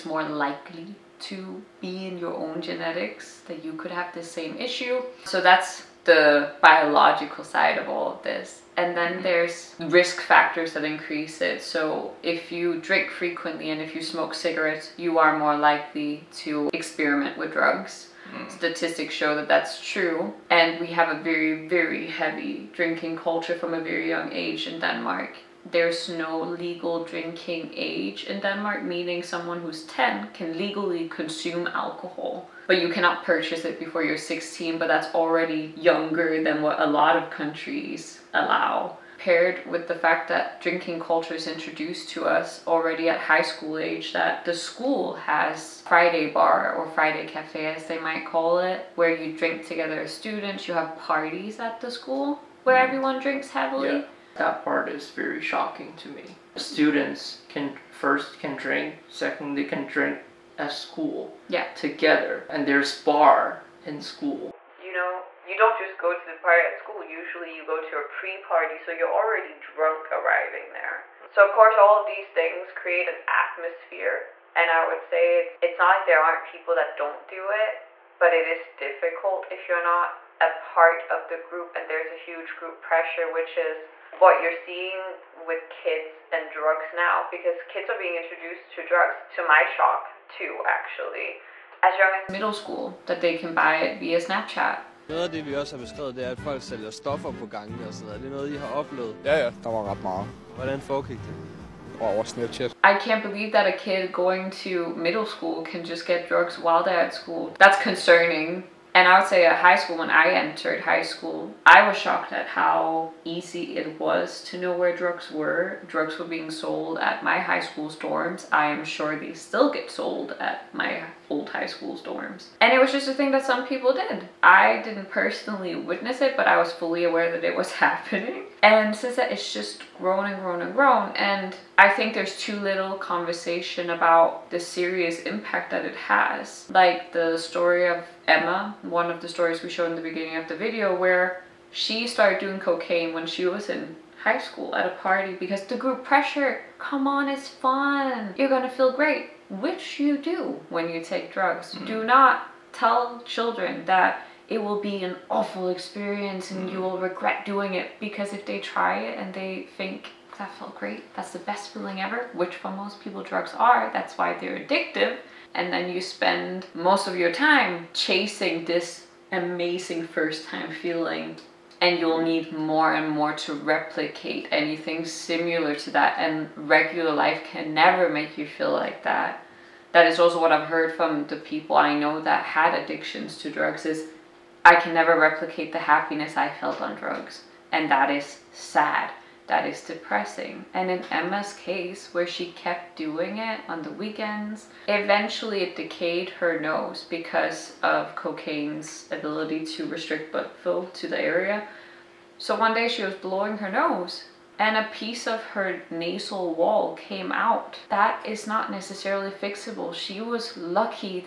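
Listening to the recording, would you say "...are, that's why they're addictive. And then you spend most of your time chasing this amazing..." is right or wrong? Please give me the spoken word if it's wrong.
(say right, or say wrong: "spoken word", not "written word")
right.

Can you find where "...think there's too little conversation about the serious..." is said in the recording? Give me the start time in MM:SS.
02:11.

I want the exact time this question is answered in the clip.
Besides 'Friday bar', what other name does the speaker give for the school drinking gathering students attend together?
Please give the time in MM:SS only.
00:46.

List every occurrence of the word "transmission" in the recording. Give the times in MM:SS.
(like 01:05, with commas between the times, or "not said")
not said.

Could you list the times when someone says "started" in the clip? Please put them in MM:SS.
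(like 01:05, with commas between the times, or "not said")
02:22.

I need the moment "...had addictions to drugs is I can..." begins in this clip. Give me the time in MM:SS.
03:02.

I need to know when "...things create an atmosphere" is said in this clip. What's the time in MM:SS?
01:12.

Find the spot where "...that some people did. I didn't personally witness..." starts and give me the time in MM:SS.
02:03.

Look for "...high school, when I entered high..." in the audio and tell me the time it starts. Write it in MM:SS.
01:49.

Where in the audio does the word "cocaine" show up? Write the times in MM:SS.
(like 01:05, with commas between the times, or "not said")
02:22, 03:18.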